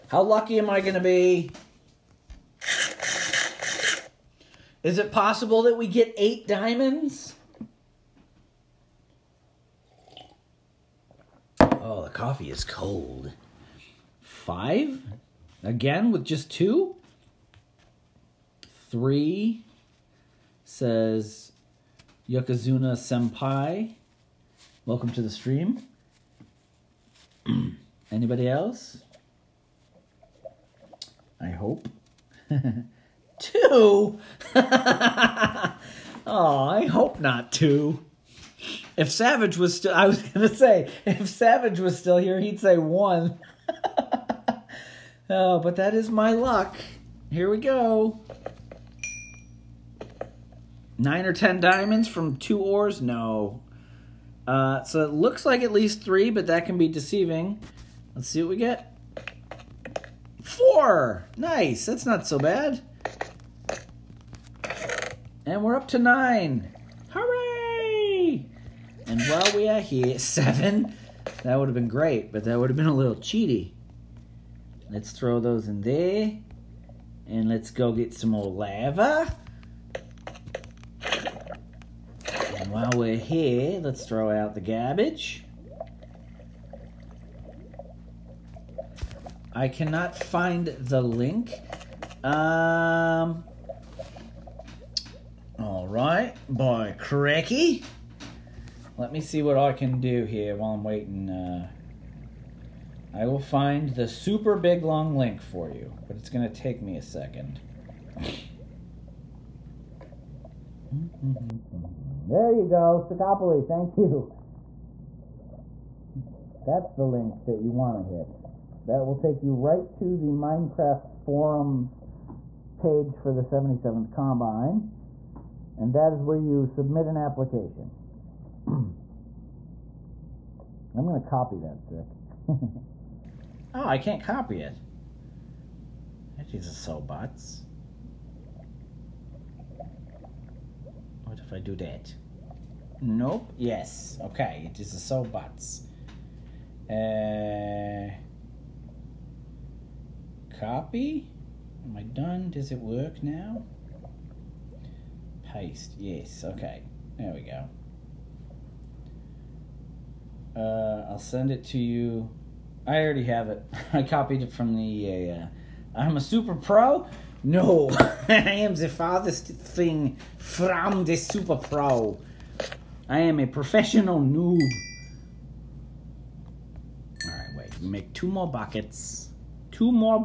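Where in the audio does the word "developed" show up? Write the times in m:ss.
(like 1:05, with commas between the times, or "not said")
not said.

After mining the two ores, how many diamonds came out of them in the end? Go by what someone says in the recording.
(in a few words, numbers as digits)
4.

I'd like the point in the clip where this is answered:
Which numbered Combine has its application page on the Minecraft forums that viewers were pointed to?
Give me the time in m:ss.
2:03.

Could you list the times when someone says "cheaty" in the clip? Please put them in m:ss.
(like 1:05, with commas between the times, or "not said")
1:13.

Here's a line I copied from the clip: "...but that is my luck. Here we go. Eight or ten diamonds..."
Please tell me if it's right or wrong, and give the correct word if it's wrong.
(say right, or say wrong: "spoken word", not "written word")
wrong: "Nine", not "Eight".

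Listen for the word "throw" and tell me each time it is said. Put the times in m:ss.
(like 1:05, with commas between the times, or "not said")
1:15, 1:24.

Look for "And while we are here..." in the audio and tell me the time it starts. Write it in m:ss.
1:09.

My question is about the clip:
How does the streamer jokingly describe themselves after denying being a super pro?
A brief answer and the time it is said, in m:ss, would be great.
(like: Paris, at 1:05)
professional noob, at 2:53.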